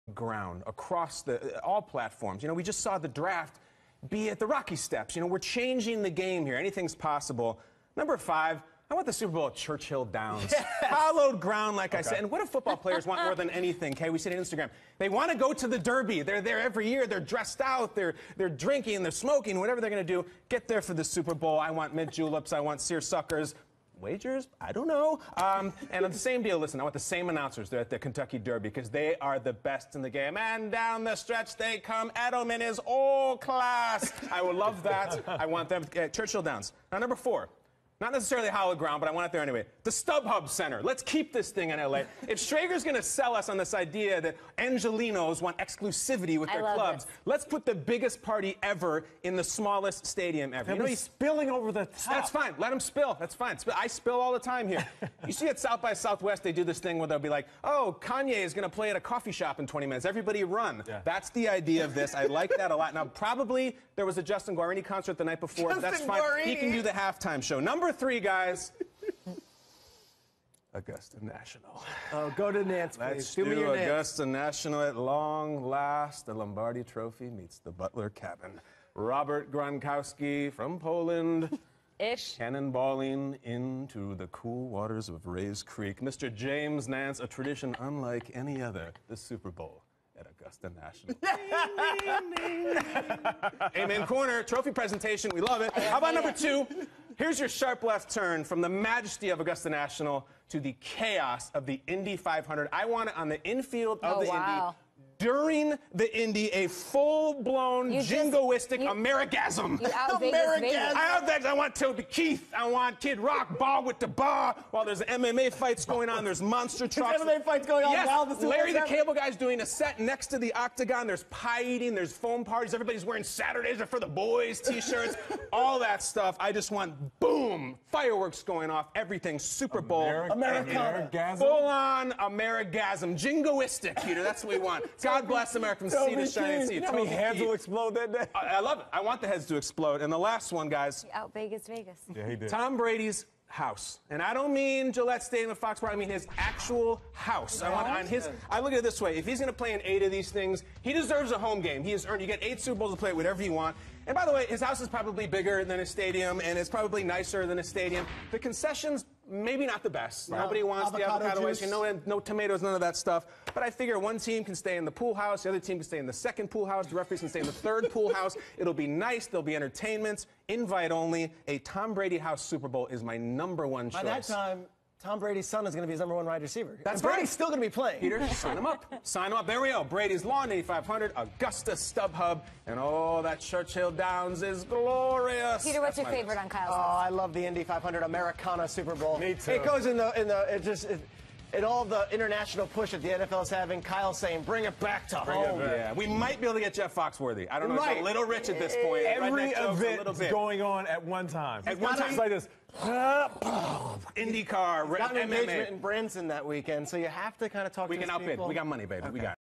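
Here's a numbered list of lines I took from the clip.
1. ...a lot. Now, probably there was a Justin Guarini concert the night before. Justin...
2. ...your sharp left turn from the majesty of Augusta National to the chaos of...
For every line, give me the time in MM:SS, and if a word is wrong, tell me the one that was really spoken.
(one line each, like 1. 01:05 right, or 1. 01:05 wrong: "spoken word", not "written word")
1. 01:02 right
2. 01:37 right.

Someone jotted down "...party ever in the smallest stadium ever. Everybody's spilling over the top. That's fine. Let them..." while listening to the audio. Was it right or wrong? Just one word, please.
right.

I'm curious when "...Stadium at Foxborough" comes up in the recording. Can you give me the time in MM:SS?
02:25.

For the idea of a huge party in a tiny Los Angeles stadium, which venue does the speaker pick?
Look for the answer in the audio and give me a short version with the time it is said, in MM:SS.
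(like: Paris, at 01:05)
StubHub Center, at 00:39.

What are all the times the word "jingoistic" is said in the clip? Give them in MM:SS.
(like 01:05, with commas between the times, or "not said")
01:47, 02:13.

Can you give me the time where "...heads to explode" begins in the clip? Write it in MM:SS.
02:19.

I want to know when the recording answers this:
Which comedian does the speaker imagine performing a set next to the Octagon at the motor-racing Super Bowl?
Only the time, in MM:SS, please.
01:58.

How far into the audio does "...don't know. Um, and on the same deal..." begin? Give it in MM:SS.
00:24.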